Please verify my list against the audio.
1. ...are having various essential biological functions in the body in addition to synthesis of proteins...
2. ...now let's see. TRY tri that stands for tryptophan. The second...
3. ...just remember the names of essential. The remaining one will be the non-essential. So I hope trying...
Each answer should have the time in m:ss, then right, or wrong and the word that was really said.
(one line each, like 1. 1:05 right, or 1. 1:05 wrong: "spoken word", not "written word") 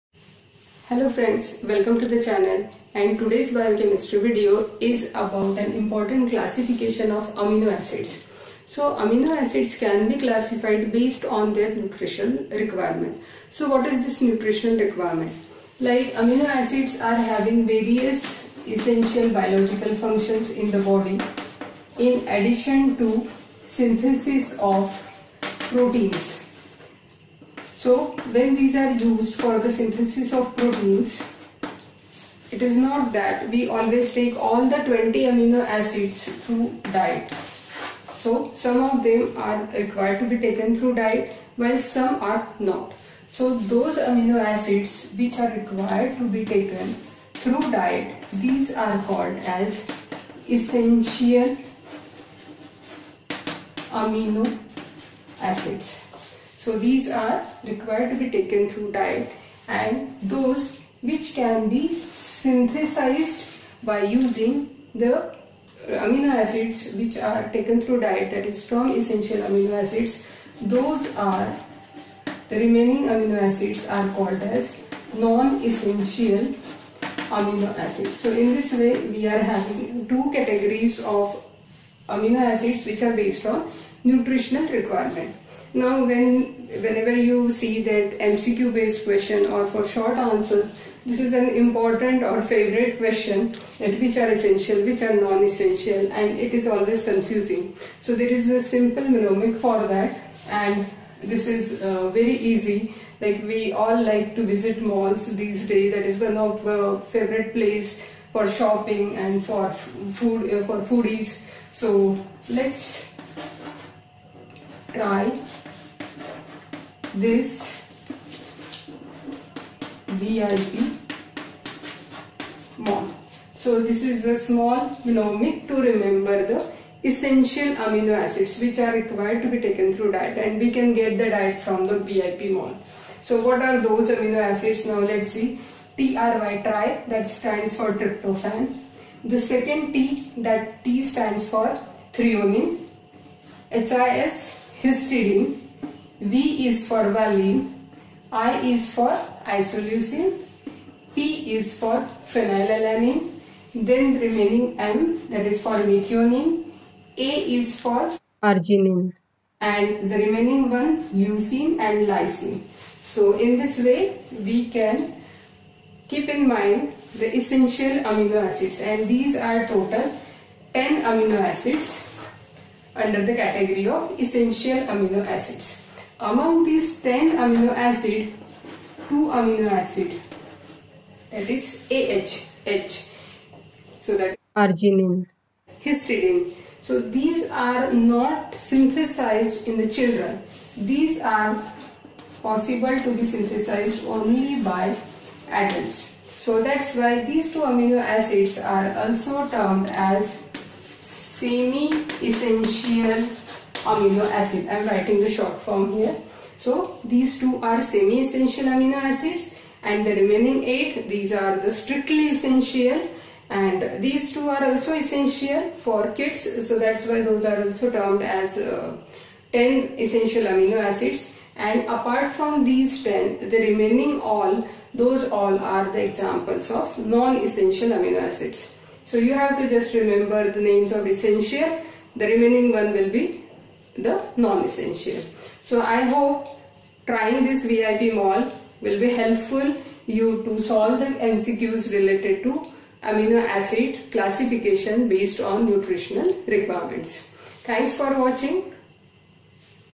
1. 0:16 right
2. 2:14 right
3. 3:49 right.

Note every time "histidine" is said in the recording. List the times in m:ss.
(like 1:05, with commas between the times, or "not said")
2:24, 3:05.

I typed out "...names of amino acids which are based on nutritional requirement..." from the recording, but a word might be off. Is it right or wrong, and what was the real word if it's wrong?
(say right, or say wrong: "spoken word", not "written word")
wrong: "categories", not "names".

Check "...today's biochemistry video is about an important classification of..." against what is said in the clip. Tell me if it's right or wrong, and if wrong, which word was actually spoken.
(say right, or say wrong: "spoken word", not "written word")
right.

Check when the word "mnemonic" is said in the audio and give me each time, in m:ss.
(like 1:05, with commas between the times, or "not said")
1:39, 2:05.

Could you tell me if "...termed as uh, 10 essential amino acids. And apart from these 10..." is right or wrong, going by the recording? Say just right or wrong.
right.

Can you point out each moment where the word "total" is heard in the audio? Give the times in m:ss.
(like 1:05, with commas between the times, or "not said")
2:49.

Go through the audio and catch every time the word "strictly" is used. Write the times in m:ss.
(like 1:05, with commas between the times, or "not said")
3:31.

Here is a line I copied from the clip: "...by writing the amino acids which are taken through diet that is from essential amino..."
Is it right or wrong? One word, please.
wrong.